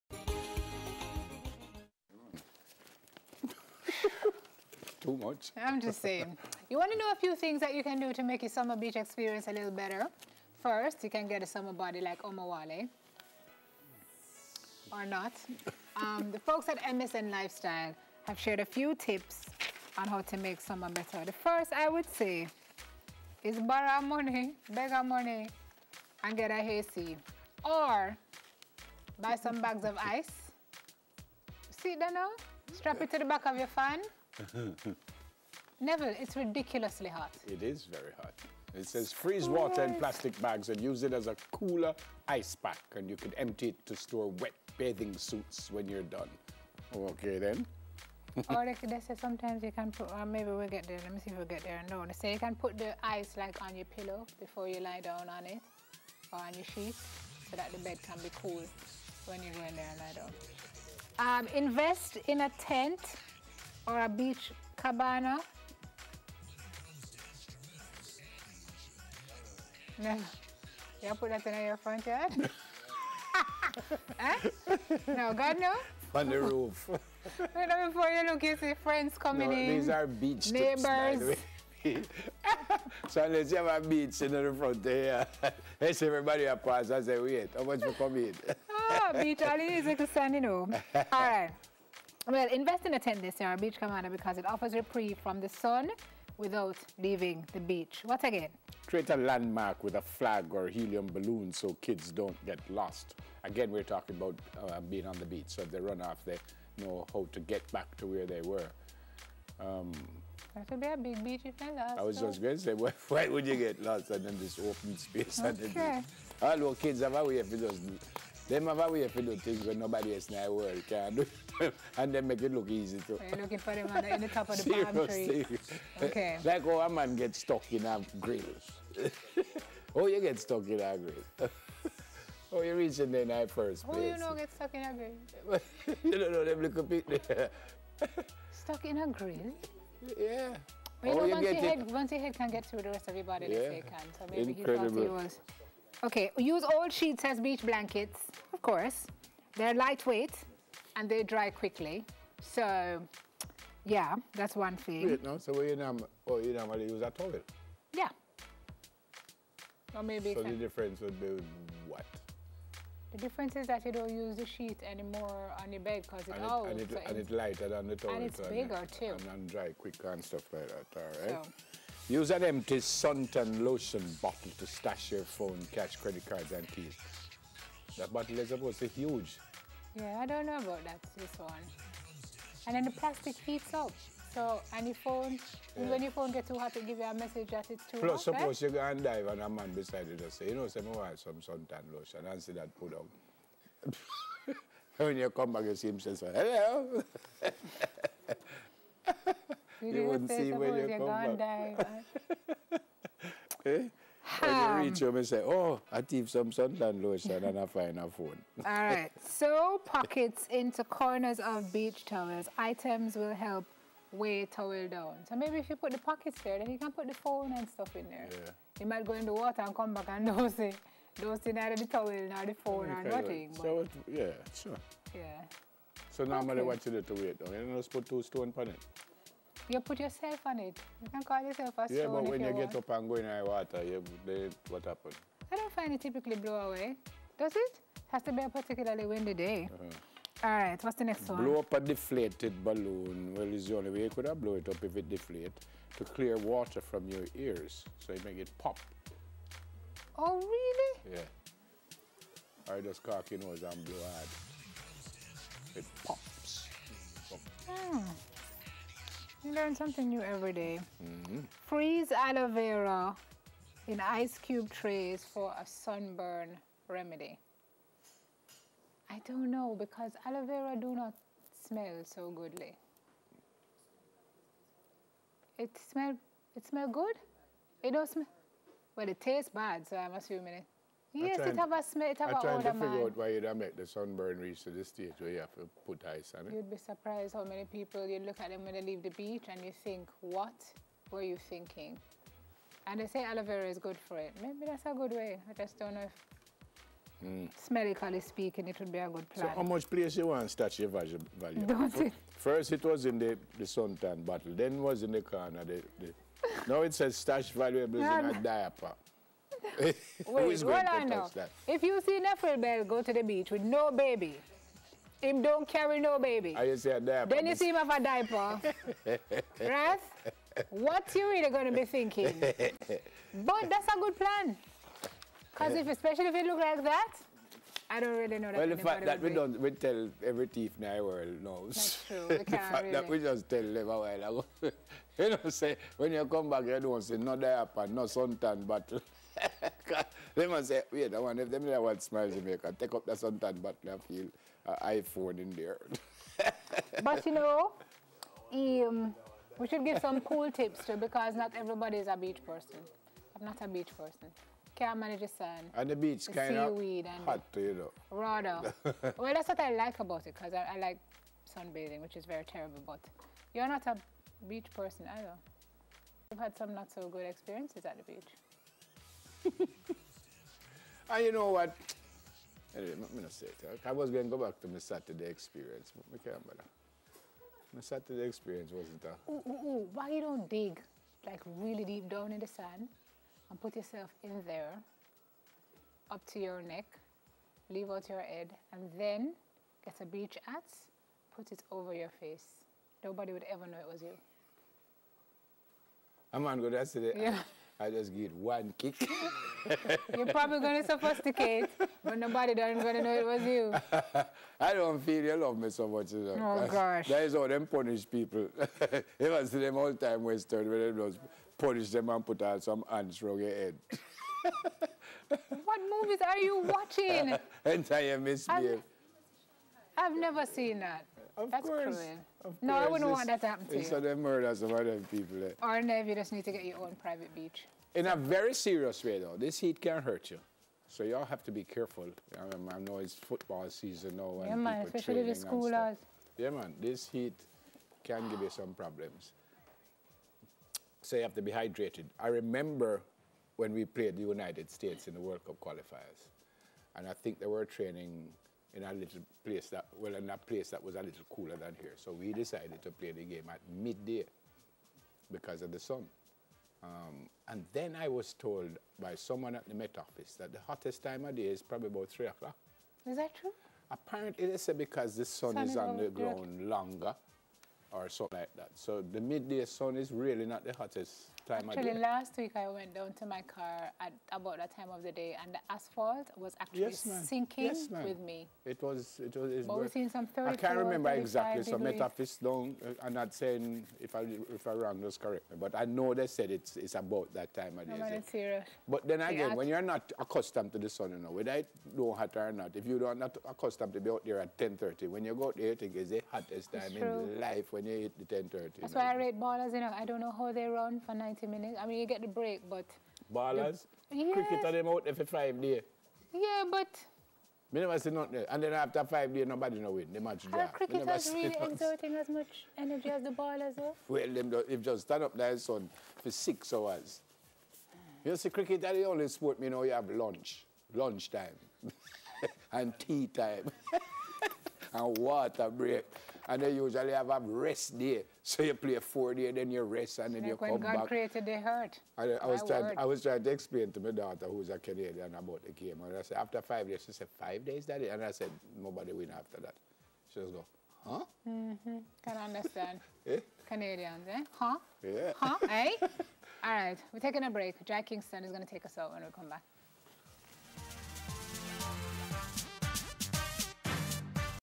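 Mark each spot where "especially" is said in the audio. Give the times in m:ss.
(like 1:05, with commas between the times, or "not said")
5:25, 7:14.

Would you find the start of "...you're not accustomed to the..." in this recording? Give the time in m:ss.
8:09.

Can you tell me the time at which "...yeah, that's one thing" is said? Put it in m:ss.
2:33.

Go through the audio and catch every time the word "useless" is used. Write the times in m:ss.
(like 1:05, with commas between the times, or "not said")
not said.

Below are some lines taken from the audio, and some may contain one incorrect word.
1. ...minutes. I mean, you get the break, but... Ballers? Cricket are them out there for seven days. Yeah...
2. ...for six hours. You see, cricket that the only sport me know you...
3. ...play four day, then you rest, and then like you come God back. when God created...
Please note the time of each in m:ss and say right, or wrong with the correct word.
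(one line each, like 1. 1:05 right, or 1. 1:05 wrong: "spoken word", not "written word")
1. 8:21 wrong: "five", not "seven"
2. 8:36 right
3. 8:48 right.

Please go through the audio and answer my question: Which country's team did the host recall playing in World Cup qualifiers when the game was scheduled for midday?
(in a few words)
United States.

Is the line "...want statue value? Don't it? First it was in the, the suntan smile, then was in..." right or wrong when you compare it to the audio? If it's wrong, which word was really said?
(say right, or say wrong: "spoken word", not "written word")
wrong: "bottle", not "smile".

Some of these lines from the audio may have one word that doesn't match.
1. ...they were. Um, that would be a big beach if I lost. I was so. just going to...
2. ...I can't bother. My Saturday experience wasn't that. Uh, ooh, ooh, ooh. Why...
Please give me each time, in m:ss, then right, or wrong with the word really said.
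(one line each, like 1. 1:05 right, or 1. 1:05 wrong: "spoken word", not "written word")
1. 1:48 right
2. 6:16 right.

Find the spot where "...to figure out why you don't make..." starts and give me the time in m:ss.
4:42.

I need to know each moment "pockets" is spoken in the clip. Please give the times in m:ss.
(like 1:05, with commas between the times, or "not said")
3:29, 3:35.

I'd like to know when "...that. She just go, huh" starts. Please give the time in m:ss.
8:59.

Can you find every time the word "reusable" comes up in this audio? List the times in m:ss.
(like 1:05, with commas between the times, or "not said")
not said.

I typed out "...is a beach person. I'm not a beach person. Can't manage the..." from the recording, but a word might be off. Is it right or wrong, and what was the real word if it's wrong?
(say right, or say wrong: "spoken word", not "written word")
right.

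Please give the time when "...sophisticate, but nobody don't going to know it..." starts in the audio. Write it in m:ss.
6:40.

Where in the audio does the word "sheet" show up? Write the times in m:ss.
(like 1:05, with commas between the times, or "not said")
0:56, 2:26, 2:44.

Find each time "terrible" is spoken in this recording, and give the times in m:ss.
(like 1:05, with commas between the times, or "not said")
6:02.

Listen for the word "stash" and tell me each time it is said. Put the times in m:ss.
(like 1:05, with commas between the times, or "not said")
2:54, 5:07.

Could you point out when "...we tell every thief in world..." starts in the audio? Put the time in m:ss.
5:29.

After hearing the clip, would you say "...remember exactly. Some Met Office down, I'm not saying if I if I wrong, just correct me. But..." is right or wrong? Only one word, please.
right.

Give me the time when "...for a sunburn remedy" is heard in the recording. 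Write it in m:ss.
4:25.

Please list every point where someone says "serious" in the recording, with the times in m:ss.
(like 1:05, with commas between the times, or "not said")
7:08, 8:08.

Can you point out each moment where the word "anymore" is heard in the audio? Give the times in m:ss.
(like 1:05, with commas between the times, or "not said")
2:44.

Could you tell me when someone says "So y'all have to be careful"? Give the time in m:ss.
7:10.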